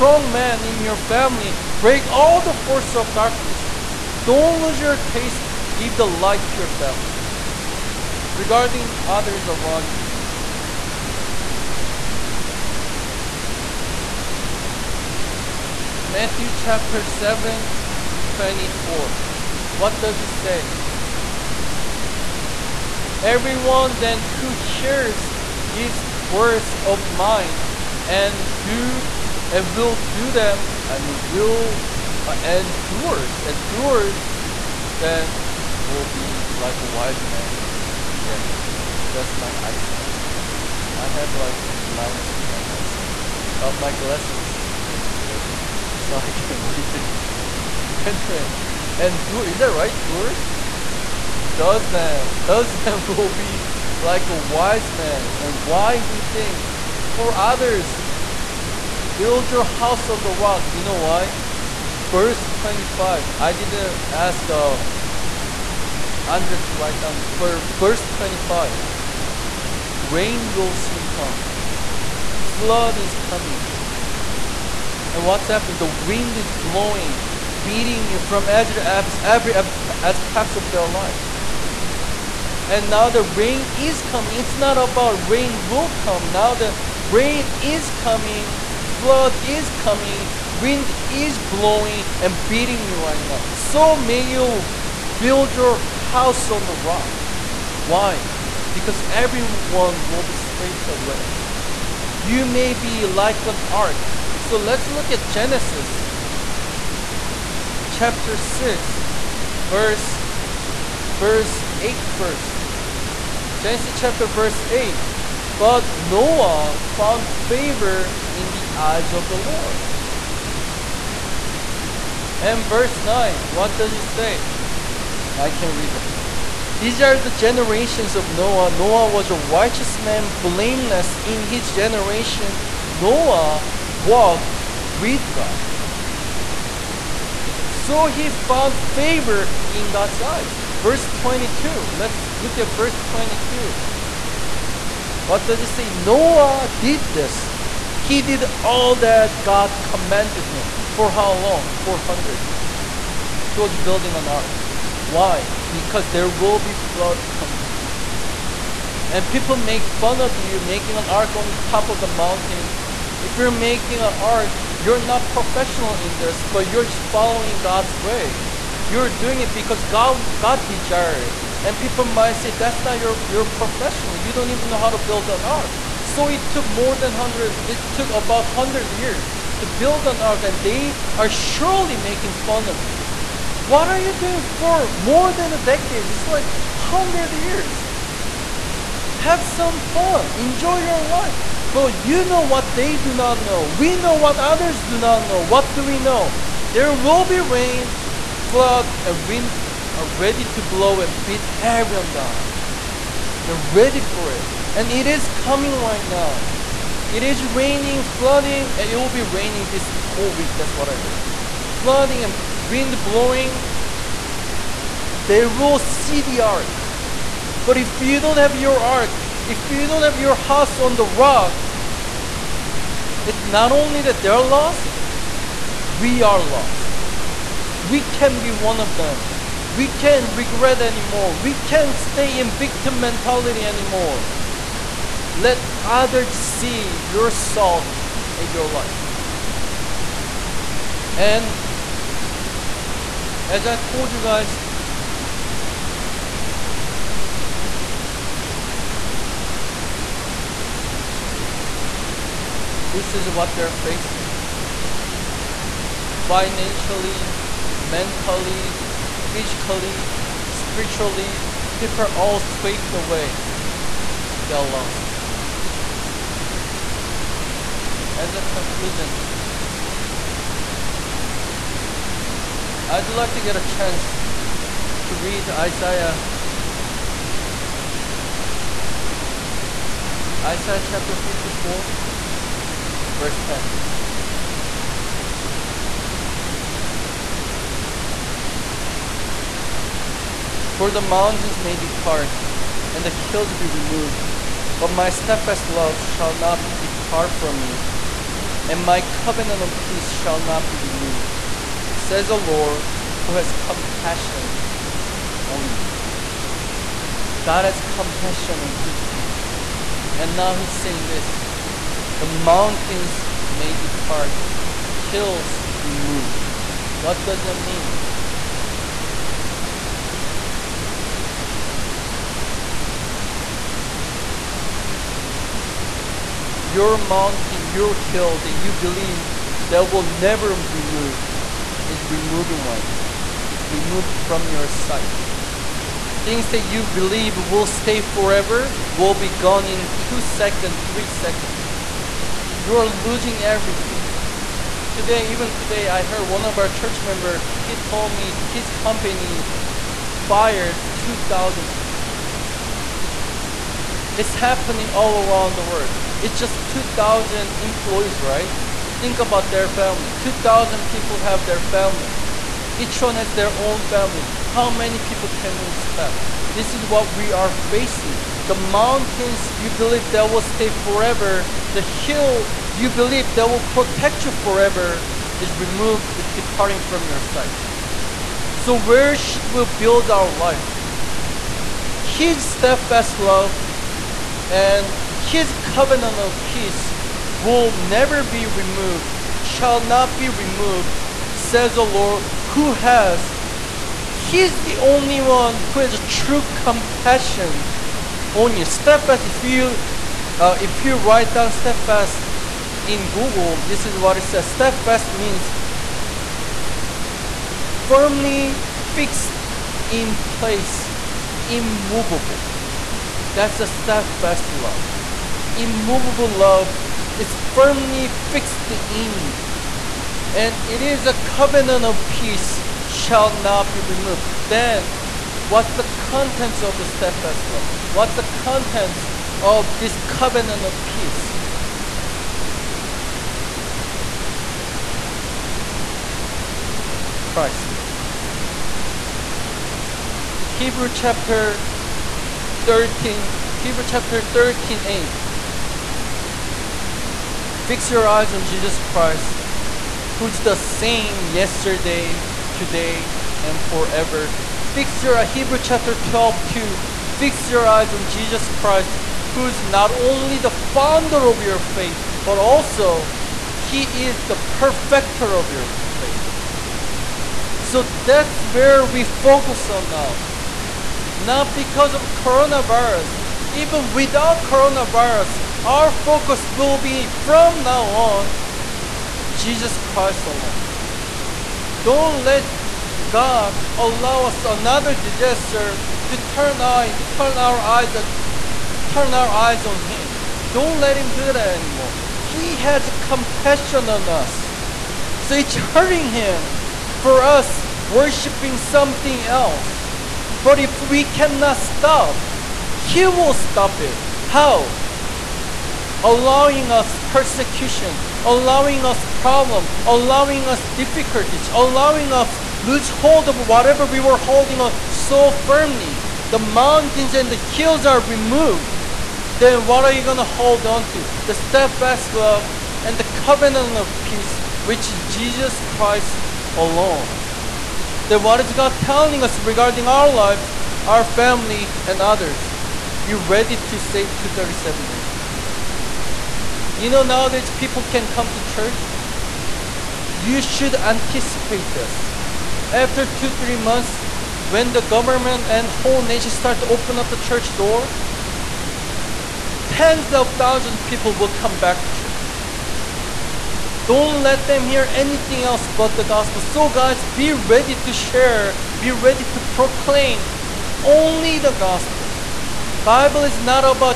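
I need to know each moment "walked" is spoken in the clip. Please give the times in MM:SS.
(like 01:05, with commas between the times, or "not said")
02:13.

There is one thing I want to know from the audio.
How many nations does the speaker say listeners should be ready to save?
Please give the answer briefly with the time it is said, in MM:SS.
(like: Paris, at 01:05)
237, at 08:54.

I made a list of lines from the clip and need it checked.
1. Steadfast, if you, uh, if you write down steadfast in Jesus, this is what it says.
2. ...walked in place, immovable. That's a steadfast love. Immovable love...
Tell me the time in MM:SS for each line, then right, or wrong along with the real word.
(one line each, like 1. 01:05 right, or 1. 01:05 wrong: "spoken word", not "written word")
1. 06:38 wrong: "Google", not "Jesus"
2. 06:48 wrong: "fixed", not "walked".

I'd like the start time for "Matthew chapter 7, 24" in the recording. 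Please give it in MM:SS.
00:15.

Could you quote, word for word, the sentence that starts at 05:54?
It's happening all around the world.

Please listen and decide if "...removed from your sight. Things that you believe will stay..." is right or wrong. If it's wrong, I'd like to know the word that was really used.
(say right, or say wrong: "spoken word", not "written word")
right.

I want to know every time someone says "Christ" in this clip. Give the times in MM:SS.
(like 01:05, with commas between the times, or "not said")
07:17, 07:28, 07:38, 07:59, 08:45.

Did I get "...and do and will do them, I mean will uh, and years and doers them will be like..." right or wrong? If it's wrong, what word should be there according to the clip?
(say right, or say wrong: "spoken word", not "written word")
wrong: "doers", not "years".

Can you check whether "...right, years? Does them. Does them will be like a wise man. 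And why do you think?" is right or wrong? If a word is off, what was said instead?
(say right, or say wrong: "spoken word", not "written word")
wrong: "doors", not "years".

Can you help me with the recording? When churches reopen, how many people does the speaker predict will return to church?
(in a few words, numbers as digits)
tens of thousands.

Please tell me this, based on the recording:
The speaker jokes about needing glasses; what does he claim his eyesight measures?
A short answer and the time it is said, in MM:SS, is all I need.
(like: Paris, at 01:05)
minus 10, at 00:41.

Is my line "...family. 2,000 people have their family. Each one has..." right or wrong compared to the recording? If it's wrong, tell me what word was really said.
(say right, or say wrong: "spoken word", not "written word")
right.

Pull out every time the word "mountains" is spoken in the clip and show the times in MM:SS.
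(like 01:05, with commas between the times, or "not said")
02:42, 04:51, 05:12, 05:26, 06:08, 08:36.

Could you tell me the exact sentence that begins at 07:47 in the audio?
So that's where we focus on now.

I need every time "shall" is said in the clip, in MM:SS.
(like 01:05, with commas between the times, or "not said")
04:55, 05:00, 06:29, 07:02.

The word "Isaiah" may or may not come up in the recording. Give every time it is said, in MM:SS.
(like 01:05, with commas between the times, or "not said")
04:35, 04:40.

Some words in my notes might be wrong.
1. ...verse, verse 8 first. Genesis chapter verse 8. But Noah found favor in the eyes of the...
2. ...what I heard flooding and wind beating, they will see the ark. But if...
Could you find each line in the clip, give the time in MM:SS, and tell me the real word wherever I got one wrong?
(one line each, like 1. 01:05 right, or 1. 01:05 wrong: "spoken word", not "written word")
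1. 01:49 right
2. 03:30 wrong: "blowing", not "beating".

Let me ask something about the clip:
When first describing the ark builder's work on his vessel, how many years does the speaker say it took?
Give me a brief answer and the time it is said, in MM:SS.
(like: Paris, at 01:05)
400, at 02:31.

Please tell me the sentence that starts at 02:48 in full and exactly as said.
You're doing it because God, God desired.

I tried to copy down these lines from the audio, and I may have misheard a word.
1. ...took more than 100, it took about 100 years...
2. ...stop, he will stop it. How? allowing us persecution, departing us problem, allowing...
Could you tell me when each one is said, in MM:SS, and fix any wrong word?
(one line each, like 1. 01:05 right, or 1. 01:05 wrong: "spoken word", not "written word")
1. 02:56 right
2. 08:21 wrong: "allowing", not "departing".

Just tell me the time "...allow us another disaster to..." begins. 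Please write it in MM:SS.
08:03.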